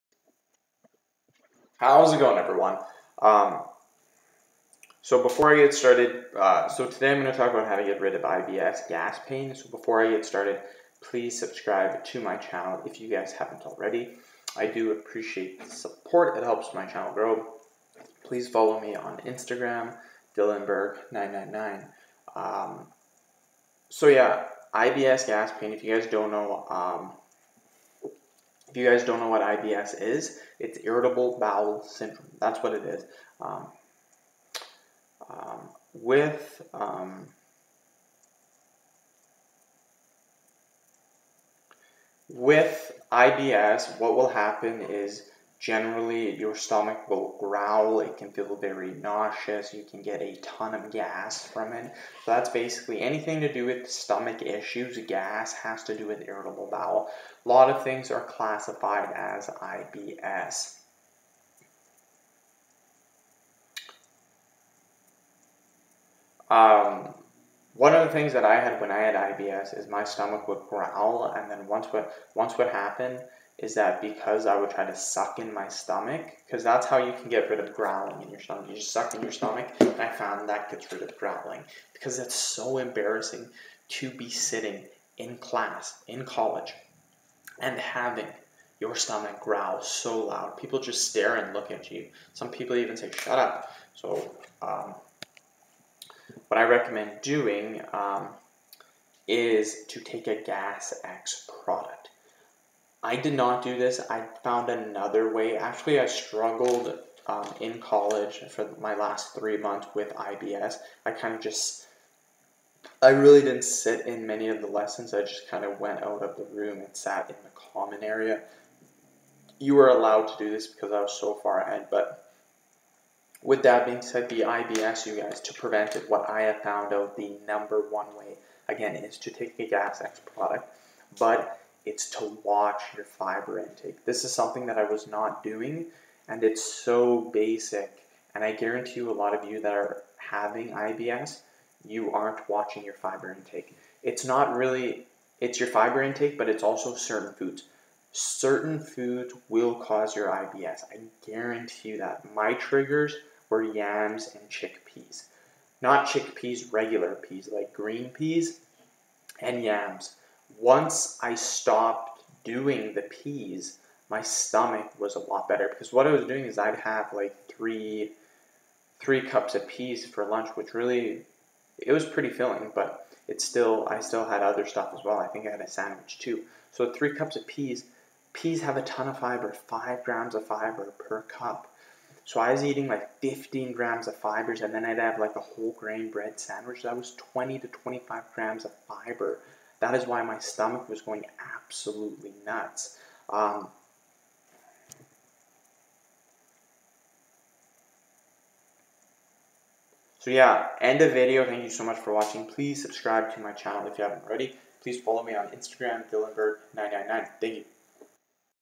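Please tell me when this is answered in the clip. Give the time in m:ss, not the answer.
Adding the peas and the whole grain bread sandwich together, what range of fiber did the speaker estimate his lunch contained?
3:07.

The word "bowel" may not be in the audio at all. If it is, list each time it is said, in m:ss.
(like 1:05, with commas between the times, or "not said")
0:31, 0:56.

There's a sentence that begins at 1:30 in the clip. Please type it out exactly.
People just stare and look at you.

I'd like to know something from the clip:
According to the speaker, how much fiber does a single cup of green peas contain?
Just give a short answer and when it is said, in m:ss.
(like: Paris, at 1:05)
5 grams, at 2:59.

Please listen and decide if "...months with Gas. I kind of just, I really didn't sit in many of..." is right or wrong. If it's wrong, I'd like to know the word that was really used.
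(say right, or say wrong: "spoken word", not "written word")
wrong: "IBS", not "Gas".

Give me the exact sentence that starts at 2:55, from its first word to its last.
I think I had a sandwich too.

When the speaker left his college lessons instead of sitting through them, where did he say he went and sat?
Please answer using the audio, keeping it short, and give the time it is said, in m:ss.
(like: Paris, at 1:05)
The common area, at 1:57.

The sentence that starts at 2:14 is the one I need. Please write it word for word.
This is something that I was not doing, and it's so basic.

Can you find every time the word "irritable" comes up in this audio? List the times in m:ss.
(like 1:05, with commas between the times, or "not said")
0:30, 0:56.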